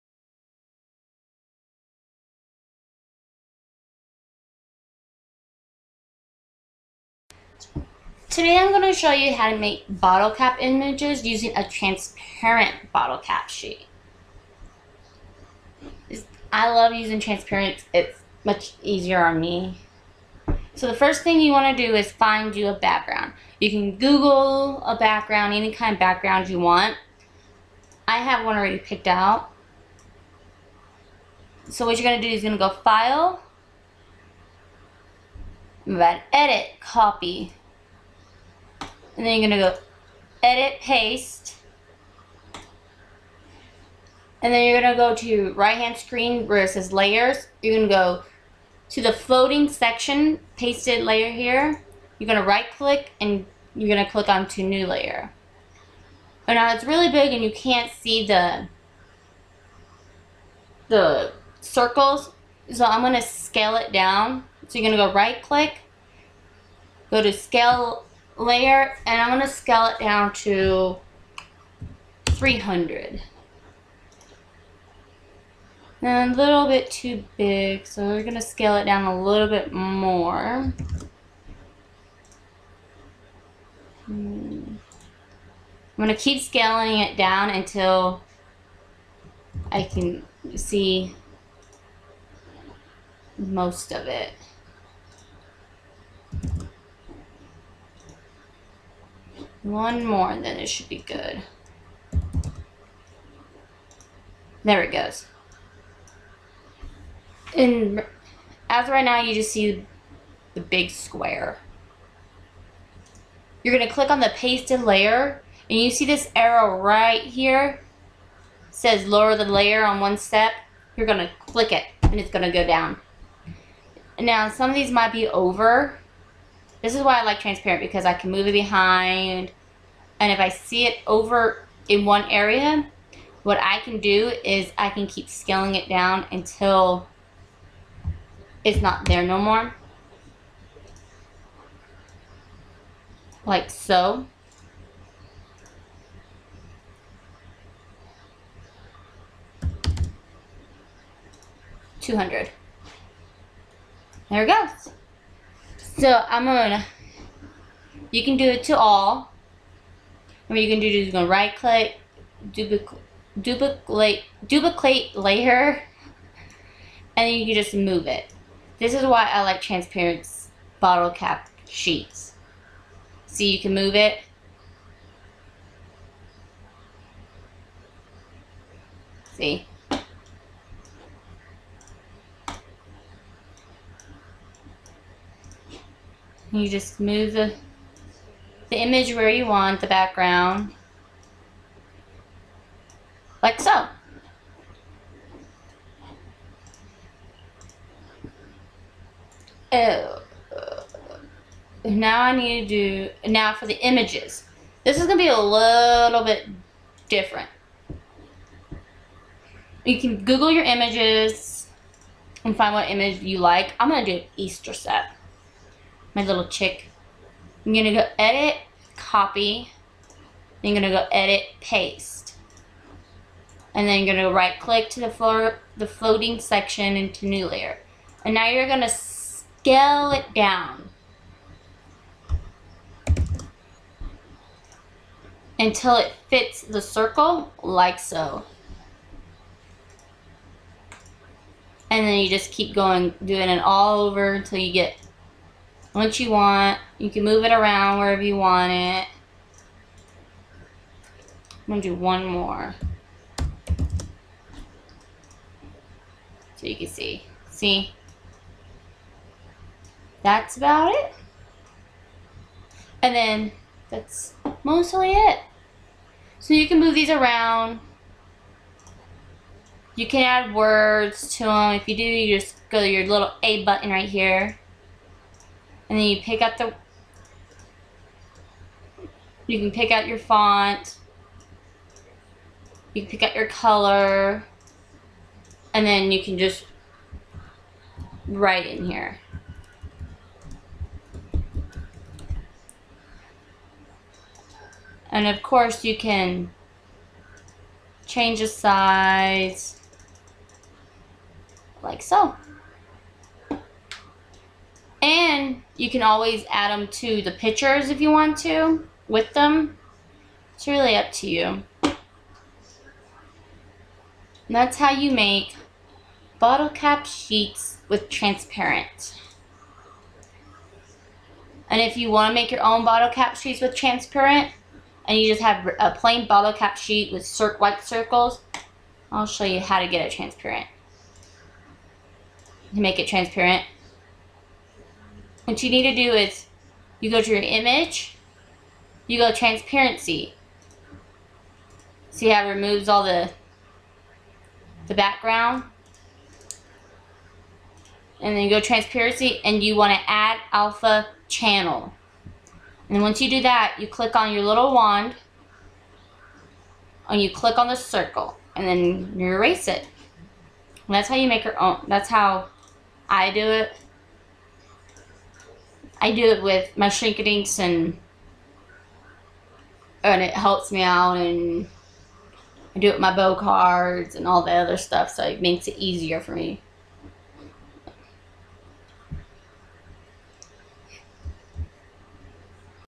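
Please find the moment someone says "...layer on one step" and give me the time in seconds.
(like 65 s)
119 s.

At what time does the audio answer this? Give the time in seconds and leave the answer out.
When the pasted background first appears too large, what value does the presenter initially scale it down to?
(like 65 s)
72 s.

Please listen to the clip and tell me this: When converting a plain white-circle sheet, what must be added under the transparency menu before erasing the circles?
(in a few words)
alpha channel.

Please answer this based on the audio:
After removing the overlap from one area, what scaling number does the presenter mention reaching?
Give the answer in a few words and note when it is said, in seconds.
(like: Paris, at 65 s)
200, at 151 s.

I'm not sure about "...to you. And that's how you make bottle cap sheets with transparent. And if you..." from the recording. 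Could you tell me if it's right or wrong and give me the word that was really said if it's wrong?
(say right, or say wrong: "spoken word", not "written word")
right.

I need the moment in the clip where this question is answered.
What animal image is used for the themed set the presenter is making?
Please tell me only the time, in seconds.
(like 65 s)
216 s.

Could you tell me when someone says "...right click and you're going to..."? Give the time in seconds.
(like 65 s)
52 s.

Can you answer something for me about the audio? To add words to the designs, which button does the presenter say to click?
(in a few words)
A button.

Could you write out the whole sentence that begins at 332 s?
To make it transparent, what you need to do is you go to your image, you go transparency.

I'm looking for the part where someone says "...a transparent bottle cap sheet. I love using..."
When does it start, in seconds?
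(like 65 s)
11 s.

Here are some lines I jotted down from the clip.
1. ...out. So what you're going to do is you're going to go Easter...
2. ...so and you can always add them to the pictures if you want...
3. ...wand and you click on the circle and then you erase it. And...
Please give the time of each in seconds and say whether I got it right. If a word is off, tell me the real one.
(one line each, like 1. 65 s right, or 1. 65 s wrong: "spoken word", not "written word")
1. 29 s wrong: "File", not "Easter"
2. 302 s right
3. 354 s right.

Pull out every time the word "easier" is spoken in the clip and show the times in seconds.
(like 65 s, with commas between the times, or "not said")
18 s, 375 s.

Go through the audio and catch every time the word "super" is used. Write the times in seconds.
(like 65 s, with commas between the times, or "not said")
not said.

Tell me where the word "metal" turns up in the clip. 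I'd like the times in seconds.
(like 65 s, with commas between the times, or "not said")
not said.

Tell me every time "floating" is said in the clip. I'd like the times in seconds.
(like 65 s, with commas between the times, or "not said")
49 s, 225 s.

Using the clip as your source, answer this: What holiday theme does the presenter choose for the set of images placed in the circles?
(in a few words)
Easter.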